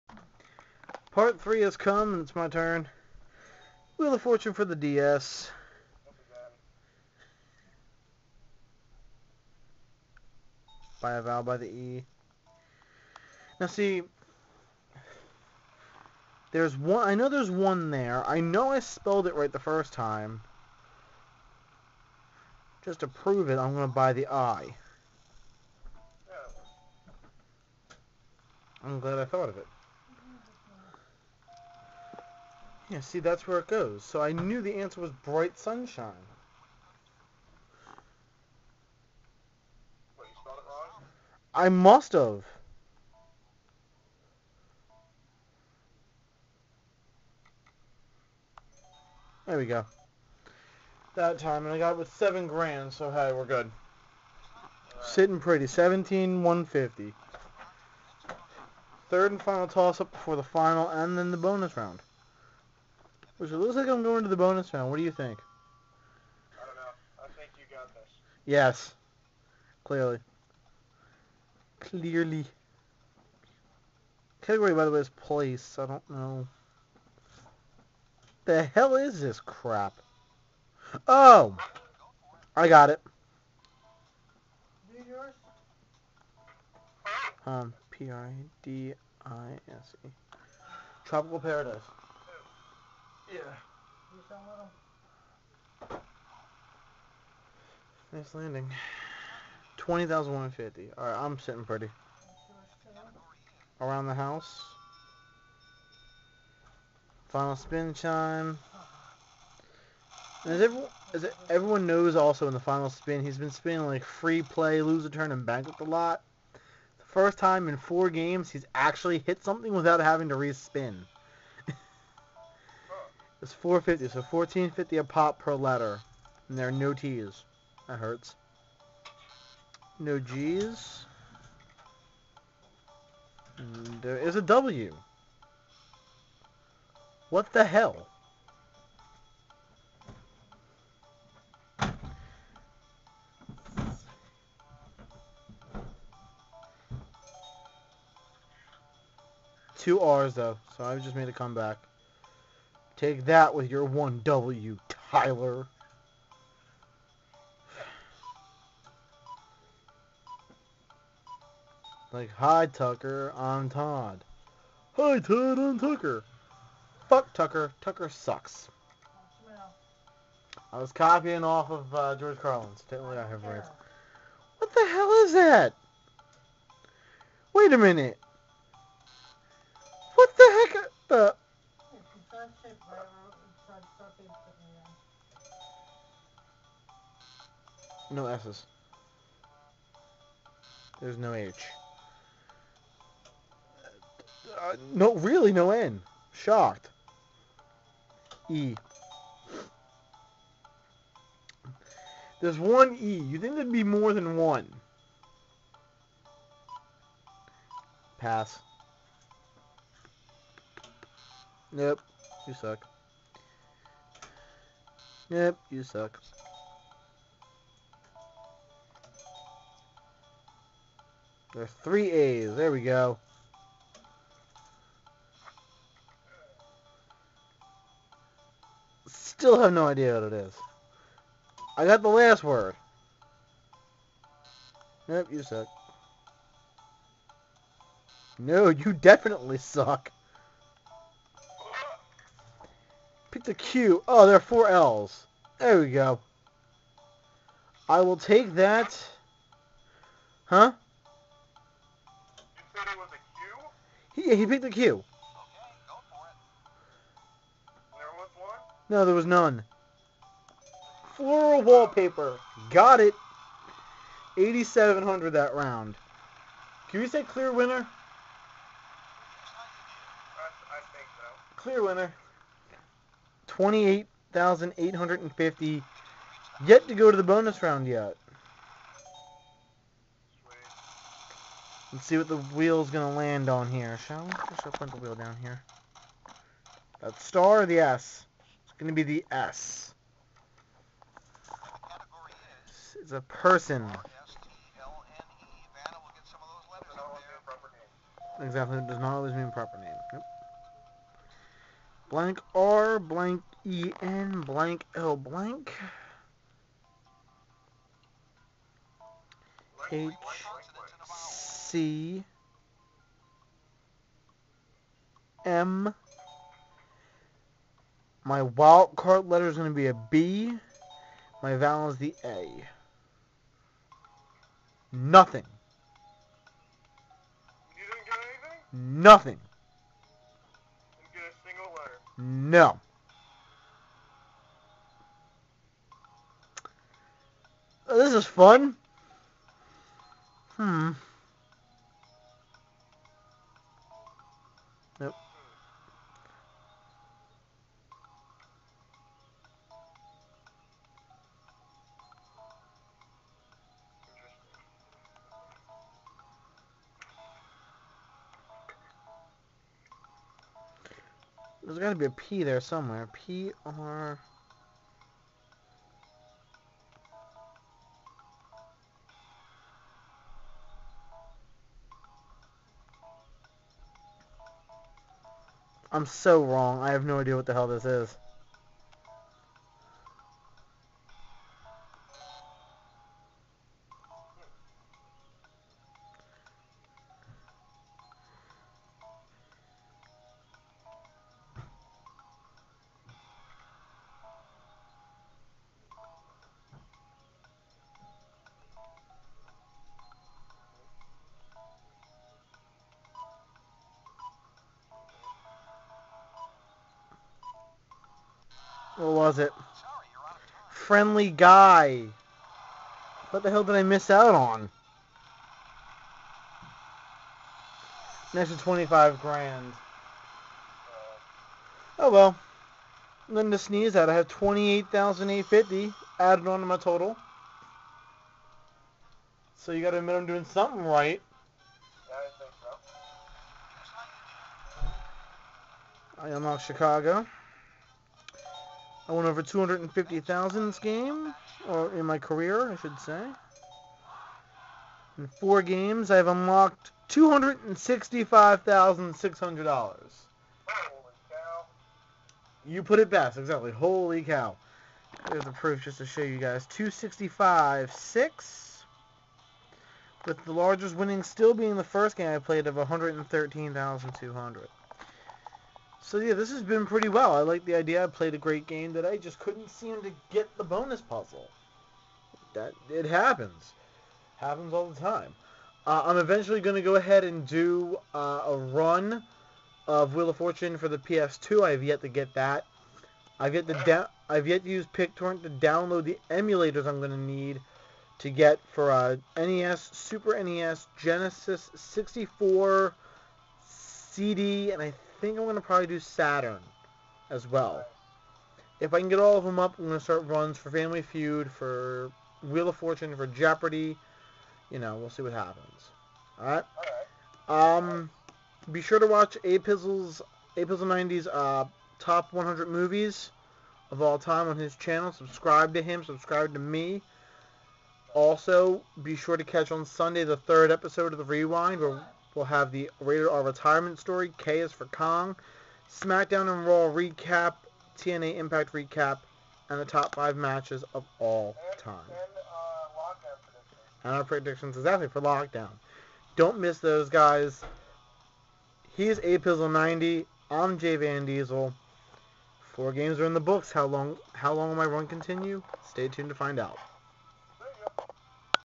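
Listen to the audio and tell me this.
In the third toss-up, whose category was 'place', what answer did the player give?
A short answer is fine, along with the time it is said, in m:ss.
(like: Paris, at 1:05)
Tropical Paradise, at 1:31.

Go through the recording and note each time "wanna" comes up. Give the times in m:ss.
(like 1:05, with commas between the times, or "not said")
not said.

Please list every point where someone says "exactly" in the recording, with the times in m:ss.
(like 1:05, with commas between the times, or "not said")
4:58, 7:33, 8:54.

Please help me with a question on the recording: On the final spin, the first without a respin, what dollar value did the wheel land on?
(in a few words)
450.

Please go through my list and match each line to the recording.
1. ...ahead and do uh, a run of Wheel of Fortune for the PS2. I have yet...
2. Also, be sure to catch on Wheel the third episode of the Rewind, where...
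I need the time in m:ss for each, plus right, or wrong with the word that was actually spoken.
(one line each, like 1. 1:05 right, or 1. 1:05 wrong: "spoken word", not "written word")
1. 7:56 right
2. 8:38 wrong: "Sunday", not "Wheel".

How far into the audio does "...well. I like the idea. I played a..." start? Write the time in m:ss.
7:47.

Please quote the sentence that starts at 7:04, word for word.
I have 28,850 added on to my total.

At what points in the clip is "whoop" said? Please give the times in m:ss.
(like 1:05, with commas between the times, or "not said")
not said.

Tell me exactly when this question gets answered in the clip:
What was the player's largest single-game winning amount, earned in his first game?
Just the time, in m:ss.
7:42.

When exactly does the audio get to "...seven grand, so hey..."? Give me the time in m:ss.
0:52.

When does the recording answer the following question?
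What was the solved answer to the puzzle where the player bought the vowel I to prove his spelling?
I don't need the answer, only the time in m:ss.
0:35.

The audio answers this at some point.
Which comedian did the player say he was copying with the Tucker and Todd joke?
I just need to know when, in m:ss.
2:52.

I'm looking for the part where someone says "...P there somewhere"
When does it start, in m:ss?
6:02.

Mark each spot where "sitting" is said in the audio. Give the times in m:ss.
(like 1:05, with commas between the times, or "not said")
0:55, 1:41.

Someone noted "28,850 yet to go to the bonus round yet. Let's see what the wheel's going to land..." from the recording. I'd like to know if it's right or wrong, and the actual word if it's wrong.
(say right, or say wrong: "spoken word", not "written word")
right.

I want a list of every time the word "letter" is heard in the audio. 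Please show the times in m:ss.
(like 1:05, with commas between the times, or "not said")
2:05, 5:19.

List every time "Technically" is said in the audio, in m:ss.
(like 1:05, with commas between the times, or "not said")
2:52.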